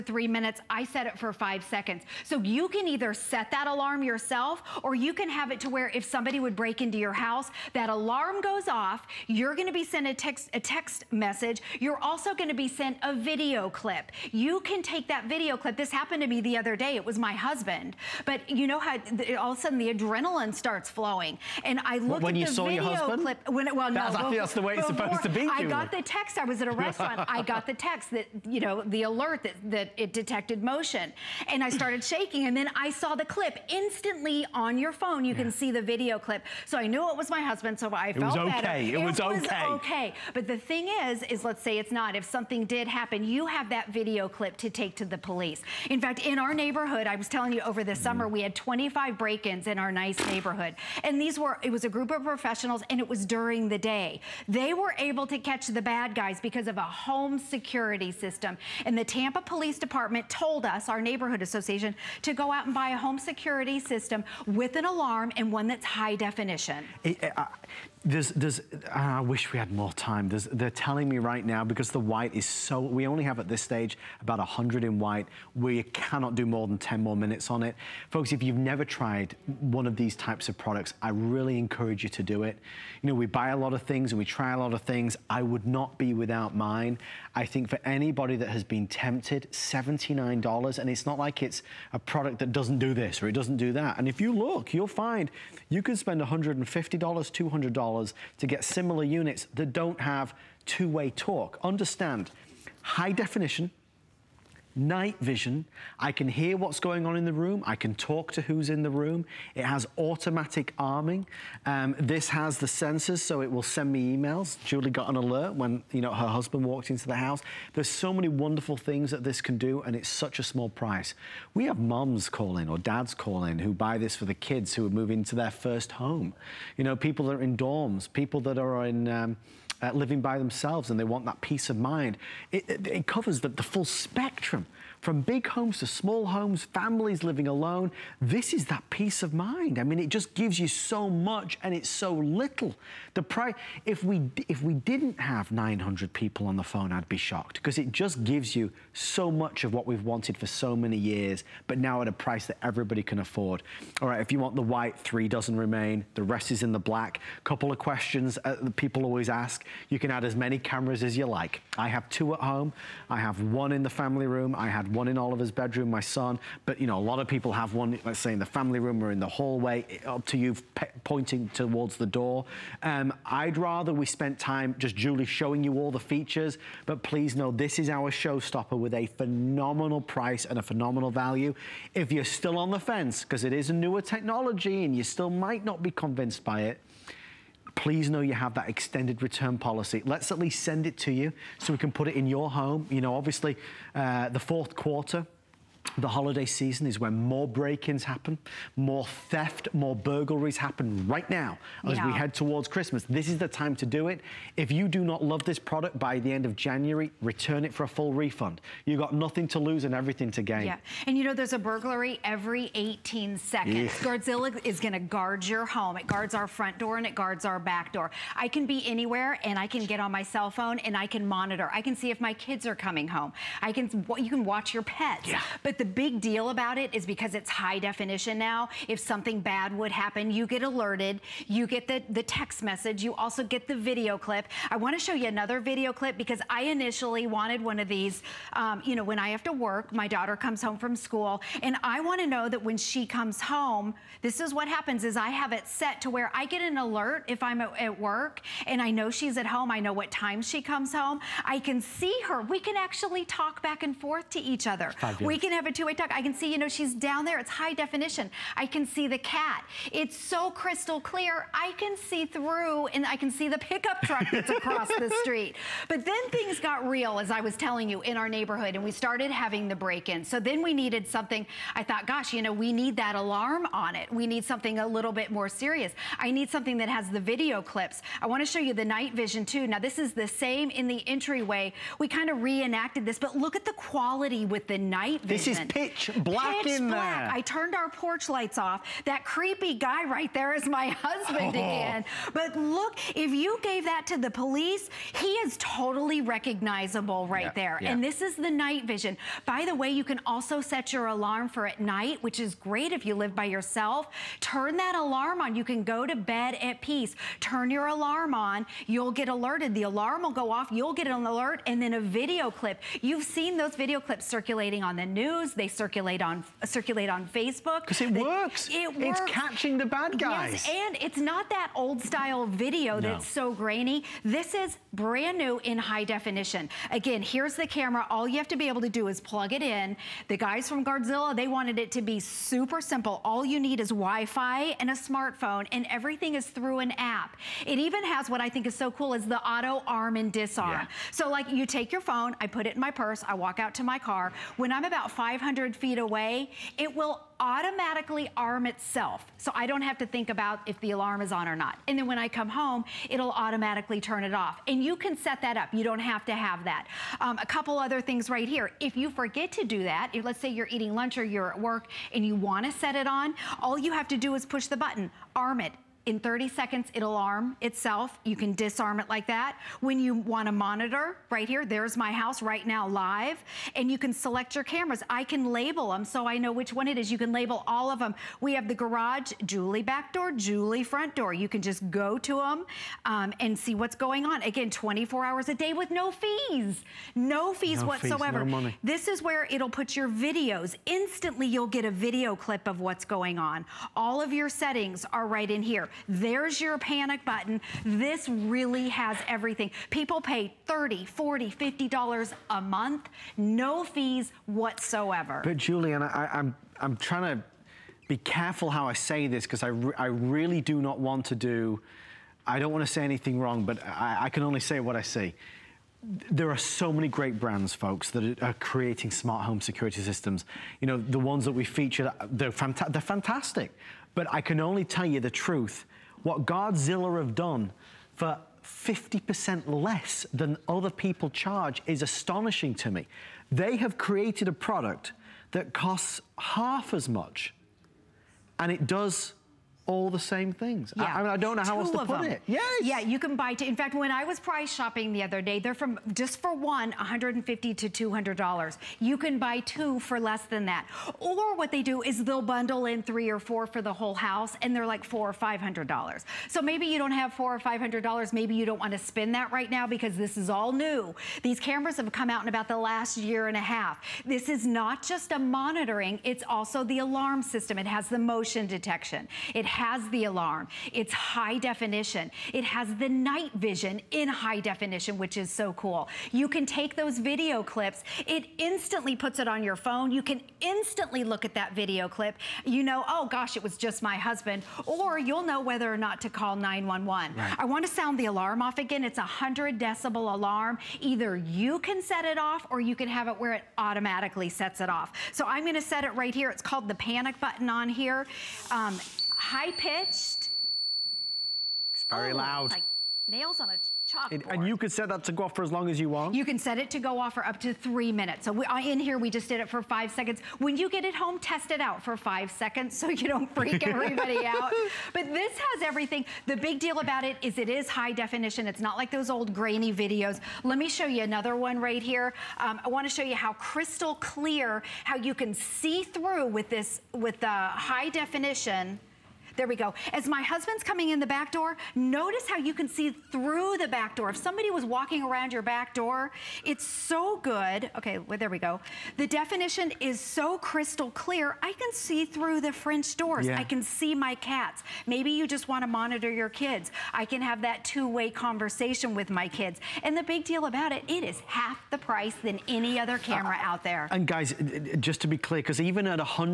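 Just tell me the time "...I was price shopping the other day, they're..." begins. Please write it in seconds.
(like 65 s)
444 s.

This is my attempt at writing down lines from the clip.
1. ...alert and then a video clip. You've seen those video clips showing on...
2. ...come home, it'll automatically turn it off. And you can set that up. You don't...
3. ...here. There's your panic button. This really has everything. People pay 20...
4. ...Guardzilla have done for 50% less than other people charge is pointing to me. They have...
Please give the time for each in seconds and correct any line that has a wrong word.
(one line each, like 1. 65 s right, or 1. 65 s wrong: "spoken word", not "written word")
1. 311 s wrong: "circulating", not "showing"
2. 352 s right
3. 395 s wrong: "30", not "20"
4. 426 s wrong: "astonishing", not "pointing".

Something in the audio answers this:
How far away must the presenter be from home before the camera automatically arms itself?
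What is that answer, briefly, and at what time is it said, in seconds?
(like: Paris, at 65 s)
500 feet, at 345 s.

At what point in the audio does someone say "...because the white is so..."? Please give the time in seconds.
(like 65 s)
71 s.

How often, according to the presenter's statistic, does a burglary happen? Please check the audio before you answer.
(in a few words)
every 18 seconds.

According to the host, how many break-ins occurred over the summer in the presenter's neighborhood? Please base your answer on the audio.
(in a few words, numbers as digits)
25.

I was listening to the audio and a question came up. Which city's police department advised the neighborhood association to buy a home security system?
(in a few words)
Tampa.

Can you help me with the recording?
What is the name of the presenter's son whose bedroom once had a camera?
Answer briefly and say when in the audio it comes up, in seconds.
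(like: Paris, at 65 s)
Oliver, at 165 s.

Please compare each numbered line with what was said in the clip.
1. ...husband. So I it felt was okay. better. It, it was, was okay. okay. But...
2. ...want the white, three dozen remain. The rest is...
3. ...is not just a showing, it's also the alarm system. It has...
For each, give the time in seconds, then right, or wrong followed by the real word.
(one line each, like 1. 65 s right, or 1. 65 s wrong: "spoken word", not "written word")
1. 37 s right
2. 154 s right
3. 464 s wrong: "monitoring", not "showing".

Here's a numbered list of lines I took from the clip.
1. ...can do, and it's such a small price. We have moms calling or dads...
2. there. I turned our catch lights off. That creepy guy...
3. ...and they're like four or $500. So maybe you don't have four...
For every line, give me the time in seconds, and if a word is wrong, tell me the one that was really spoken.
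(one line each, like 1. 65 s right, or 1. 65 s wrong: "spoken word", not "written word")
1. 119 s right
2. 287 s wrong: "porch", not "catch"
3. 454 s right.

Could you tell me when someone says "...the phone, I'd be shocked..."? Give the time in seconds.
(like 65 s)
146 s.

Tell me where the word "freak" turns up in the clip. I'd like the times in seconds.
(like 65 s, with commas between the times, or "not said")
513 s.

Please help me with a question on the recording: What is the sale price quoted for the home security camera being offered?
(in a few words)
$79.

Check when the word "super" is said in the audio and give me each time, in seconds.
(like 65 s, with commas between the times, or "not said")
332 s.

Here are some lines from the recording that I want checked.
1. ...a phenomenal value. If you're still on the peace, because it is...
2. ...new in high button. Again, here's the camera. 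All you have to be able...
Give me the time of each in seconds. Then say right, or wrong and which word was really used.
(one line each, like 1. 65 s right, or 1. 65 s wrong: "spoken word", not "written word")
1. 180 s wrong: "fence", not "peace"
2. 325 s wrong: "definition", not "button".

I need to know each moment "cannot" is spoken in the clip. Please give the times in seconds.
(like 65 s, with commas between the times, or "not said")
75 s.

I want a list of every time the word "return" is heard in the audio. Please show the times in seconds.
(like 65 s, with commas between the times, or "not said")
189 s, 207 s.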